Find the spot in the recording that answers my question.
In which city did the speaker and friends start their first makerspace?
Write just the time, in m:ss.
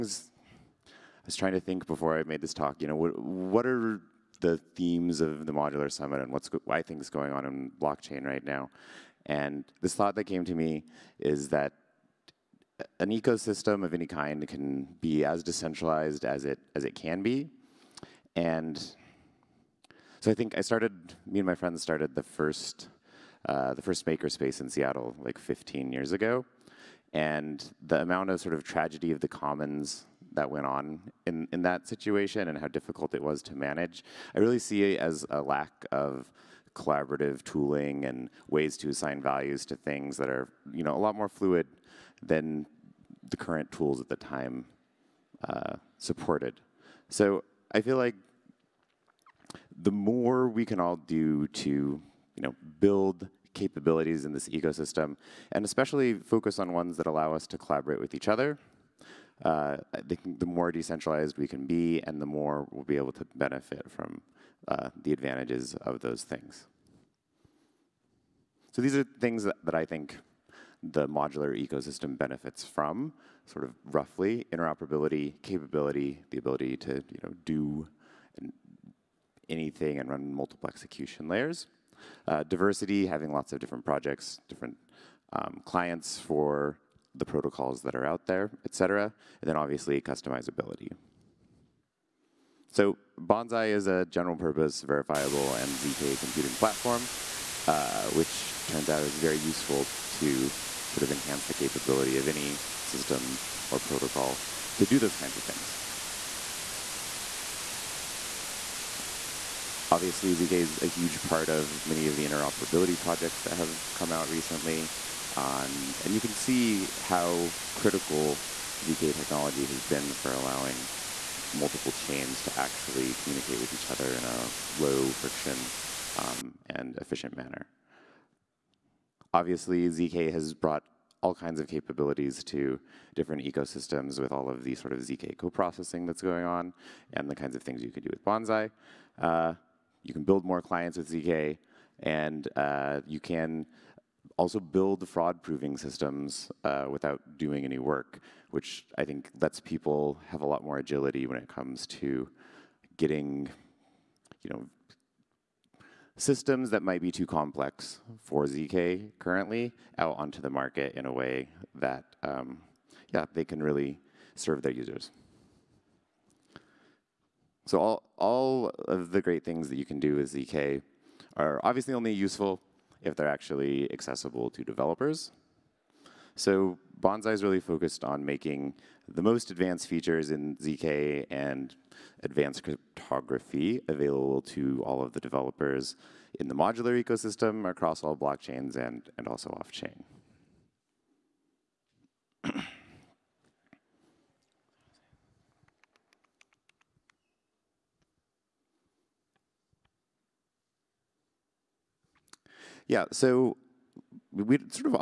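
0:24.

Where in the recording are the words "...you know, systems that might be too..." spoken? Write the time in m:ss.
2:34.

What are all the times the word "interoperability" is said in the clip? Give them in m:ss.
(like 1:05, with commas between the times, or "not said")
1:14, 1:52.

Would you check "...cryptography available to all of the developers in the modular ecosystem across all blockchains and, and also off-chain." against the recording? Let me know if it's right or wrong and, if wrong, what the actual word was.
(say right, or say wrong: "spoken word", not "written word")
right.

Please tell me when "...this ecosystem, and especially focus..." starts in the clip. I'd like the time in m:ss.
0:54.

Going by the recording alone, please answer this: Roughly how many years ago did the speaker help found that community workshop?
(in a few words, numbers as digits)
15 years.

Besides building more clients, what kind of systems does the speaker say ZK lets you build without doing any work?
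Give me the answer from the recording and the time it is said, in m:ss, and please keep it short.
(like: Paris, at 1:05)
fraud proving systems, at 2:25.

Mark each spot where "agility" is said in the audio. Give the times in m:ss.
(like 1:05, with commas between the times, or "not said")
2:30.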